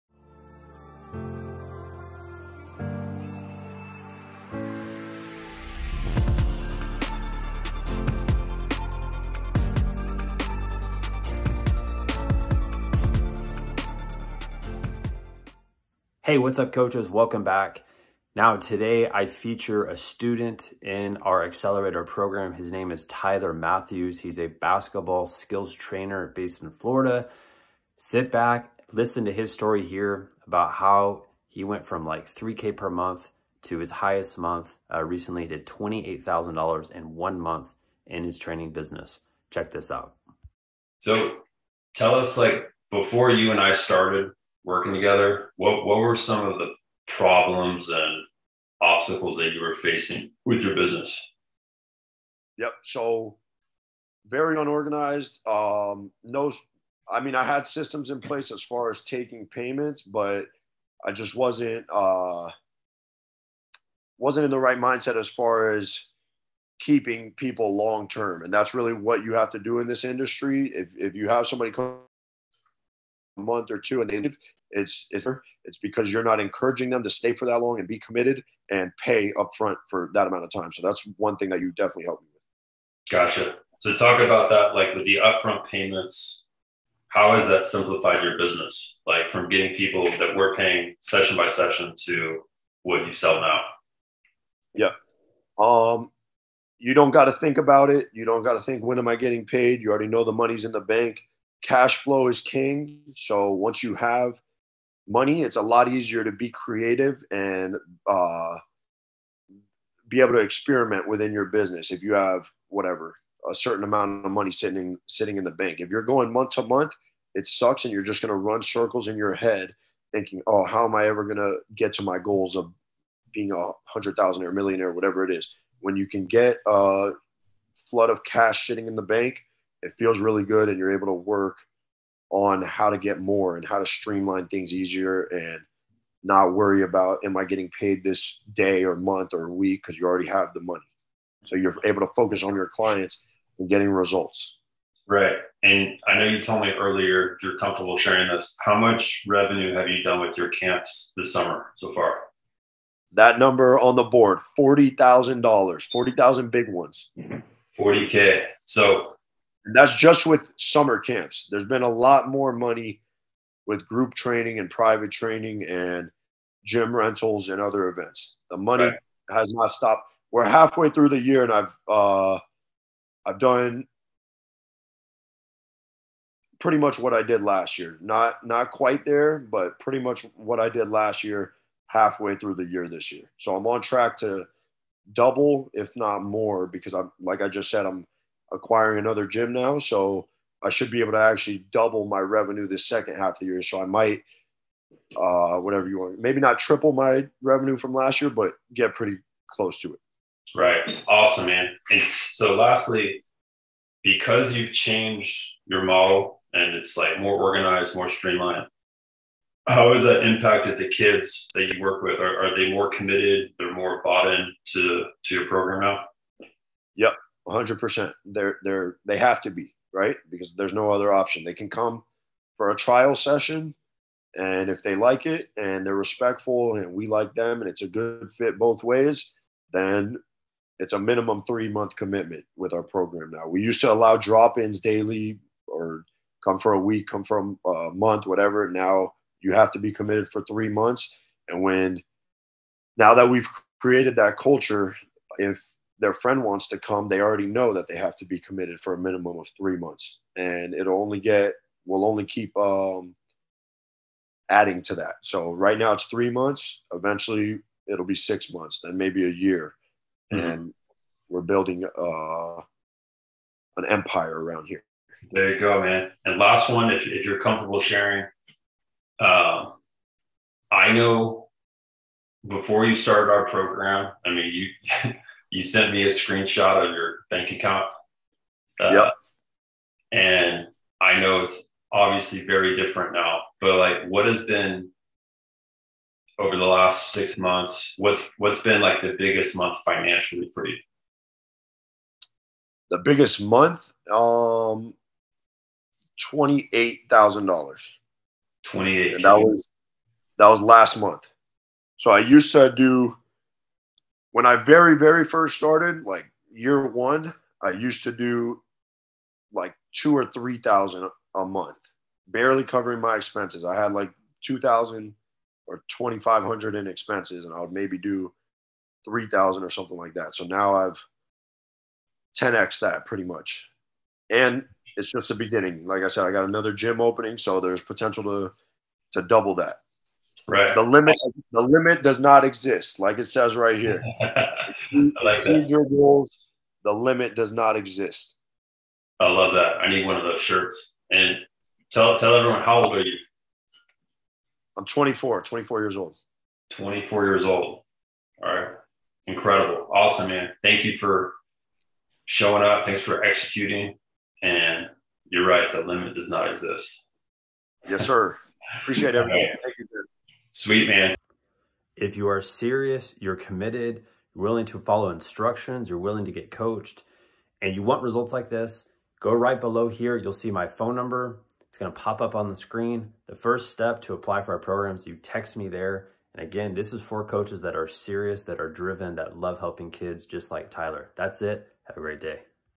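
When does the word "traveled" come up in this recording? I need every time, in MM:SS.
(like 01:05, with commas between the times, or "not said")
not said.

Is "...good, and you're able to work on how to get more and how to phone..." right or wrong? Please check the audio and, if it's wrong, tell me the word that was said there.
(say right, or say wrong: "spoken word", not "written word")
wrong: "streamline", not "phone".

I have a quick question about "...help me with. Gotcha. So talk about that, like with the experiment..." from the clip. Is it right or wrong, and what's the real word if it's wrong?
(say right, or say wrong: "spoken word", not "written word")
wrong: "upfront", not "experiment".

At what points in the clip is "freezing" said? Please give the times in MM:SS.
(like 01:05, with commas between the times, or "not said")
not said.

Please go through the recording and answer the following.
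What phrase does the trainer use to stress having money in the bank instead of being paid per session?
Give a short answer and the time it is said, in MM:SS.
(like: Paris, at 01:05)
Cash flow is king, at 01:41.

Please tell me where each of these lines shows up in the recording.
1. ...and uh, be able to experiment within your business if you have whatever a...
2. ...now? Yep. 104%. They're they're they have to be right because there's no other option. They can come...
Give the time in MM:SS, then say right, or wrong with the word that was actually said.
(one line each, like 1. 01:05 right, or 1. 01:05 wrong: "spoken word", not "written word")
1. 01:47 right
2. 03:35 wrong: "100", not "104".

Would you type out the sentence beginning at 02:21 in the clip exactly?
So you're able to focus on your clients and getting results.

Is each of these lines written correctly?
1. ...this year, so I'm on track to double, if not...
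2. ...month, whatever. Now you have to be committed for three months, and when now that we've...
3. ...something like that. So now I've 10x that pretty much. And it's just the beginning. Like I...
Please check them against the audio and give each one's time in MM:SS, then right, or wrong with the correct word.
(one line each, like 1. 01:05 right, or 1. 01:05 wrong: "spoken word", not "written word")
1. 03:02 right
2. 03:57 right
3. 05:19 right.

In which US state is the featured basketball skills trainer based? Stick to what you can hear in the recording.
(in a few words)
Florida.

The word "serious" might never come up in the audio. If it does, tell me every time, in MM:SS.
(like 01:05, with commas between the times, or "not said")
06:02, 06:17.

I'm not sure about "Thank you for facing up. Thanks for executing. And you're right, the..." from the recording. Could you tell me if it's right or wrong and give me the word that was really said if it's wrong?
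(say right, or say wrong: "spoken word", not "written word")
wrong: "showing", not "facing".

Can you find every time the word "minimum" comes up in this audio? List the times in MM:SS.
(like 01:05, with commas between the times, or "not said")
03:50, 04:08.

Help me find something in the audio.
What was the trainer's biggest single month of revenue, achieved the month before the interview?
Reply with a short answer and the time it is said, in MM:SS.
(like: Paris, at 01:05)
$28,000, at 04:56.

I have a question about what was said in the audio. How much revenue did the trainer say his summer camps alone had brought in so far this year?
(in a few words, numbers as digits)
$40,000.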